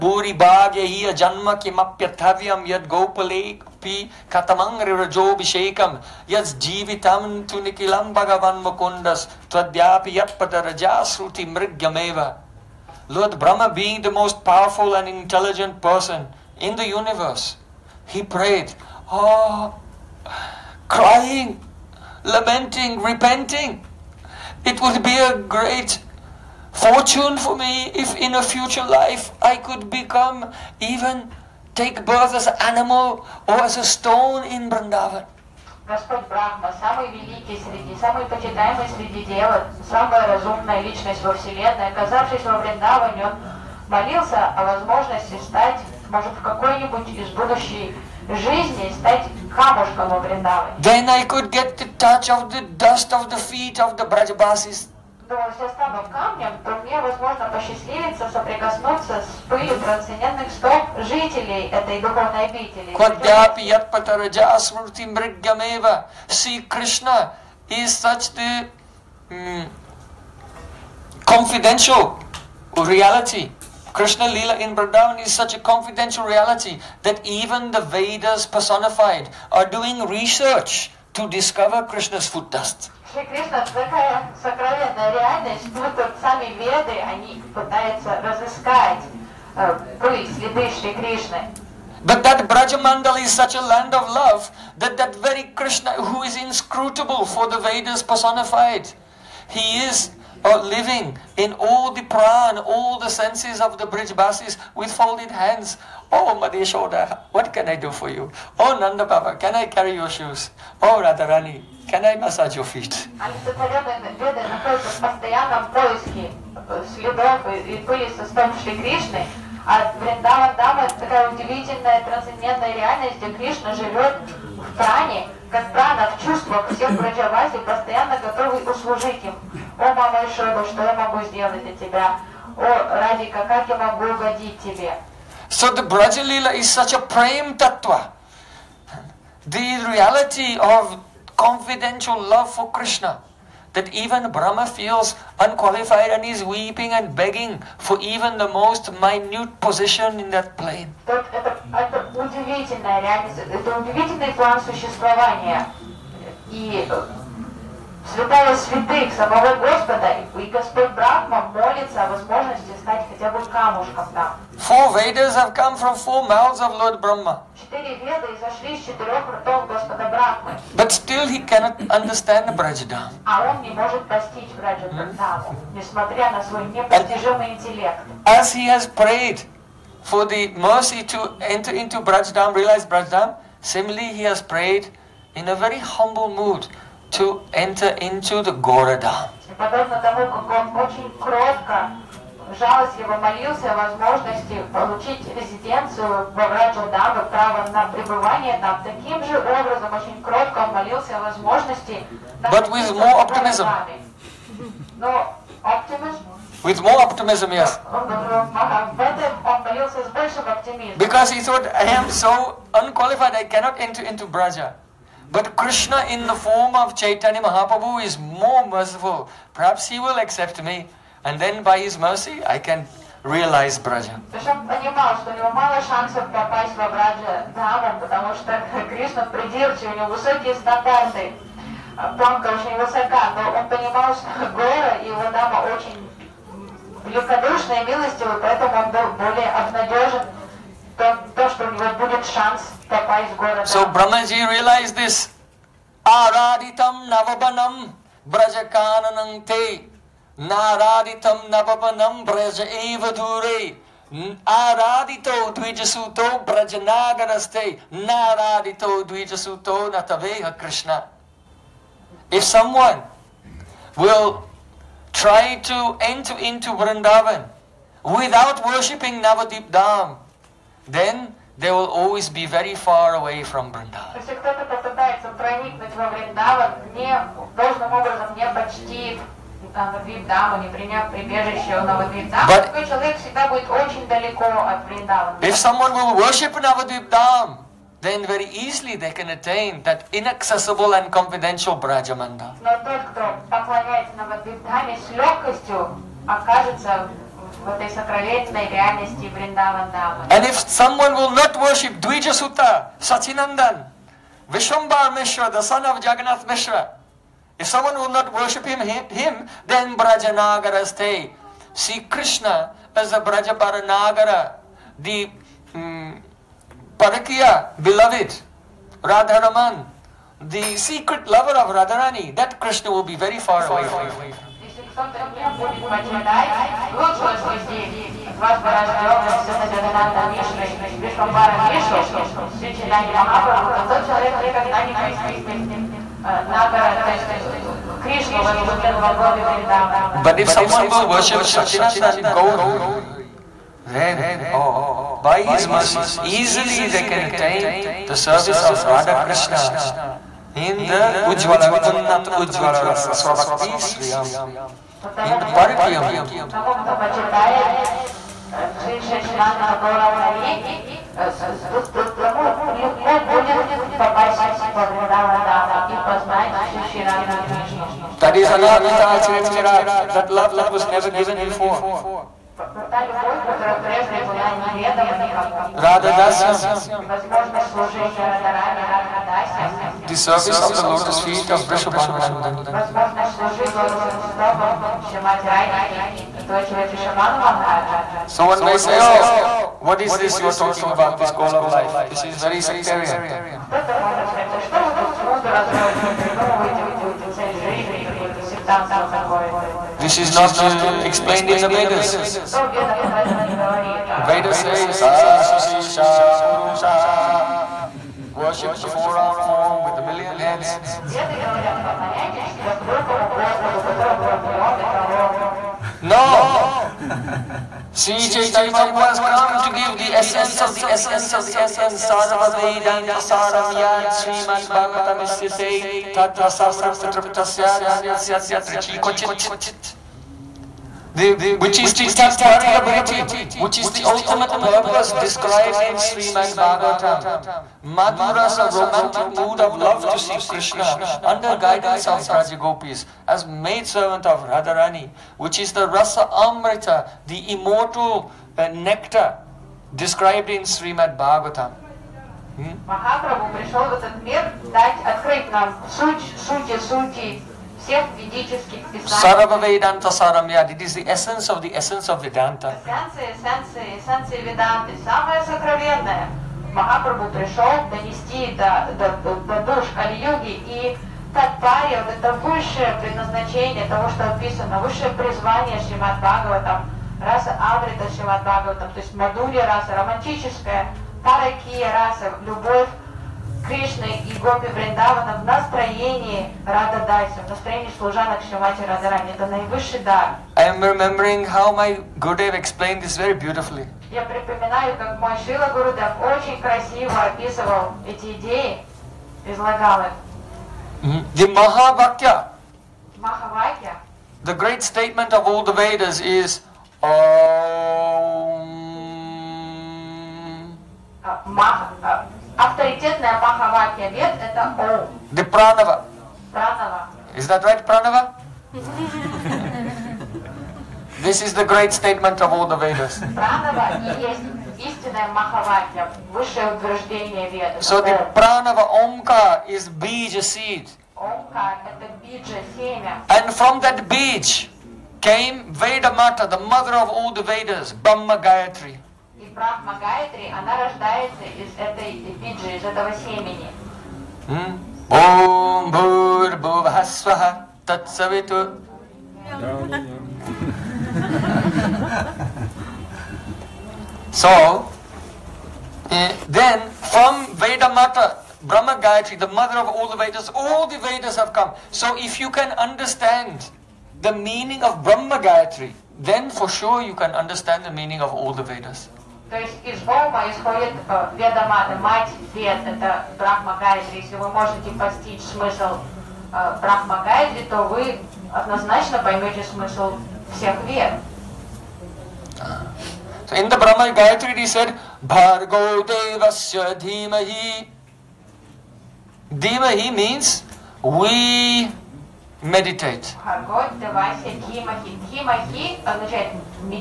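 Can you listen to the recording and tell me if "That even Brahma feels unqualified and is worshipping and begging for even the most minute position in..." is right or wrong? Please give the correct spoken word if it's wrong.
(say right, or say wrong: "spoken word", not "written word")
wrong: "weeping", not "worshipping".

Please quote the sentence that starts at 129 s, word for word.
О, что я могу сделать для тебя?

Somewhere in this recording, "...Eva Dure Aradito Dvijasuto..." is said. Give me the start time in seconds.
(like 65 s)
252 s.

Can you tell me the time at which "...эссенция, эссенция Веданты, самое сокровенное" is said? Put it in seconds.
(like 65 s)
463 s.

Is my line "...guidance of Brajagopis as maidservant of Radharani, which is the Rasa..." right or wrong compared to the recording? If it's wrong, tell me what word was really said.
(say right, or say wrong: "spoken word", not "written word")
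right.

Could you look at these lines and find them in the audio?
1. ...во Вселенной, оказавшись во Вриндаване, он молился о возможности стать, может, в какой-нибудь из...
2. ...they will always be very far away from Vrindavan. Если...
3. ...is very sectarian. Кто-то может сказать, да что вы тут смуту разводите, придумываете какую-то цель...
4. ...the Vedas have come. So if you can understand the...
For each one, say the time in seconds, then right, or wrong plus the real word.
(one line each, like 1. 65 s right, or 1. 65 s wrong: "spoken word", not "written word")
1. 41 s right
2. 271 s right
3. 392 s right
4. 560 s right.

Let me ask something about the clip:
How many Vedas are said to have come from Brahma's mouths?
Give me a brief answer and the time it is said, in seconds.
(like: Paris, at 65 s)
4, at 158 s.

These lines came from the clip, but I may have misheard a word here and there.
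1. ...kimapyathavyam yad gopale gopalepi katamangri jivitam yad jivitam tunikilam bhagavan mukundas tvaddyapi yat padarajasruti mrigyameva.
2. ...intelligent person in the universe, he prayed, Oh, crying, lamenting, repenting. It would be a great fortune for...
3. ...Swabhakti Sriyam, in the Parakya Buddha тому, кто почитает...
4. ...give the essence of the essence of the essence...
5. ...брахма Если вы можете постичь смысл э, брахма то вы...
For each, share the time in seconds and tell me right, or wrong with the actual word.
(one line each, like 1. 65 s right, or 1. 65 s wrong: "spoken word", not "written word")
1. 1 s wrong: "bishekam", not "jivitam"
2. 15 s right
3. 353 s right
4. 419 s right
5. 573 s right.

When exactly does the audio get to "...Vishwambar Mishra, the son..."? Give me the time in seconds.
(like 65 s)
304 s.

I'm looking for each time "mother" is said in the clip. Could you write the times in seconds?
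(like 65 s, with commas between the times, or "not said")
536 s, 559 s.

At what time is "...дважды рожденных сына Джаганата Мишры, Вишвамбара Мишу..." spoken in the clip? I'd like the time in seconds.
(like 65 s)
328 s.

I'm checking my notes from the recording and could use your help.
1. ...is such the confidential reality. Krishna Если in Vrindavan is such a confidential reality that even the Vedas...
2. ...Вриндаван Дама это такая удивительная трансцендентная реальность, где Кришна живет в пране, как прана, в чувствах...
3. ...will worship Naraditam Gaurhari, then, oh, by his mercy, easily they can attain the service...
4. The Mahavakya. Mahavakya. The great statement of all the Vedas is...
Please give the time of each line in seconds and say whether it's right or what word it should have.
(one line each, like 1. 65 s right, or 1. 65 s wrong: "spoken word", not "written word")
1. 67 s wrong: "Lila", not "Если"
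2. 119 s right
3. 340 s wrong: "Sachinandan", not "Naraditam"
4. 501 s right.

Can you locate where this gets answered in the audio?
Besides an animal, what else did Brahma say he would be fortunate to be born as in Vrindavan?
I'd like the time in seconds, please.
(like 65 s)
33 s.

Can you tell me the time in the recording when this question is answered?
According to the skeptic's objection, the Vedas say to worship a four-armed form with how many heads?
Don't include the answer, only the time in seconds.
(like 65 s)
409 s.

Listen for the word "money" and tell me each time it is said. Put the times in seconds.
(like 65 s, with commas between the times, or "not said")
not said.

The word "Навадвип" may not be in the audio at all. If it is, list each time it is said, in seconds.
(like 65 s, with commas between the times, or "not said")
294 s.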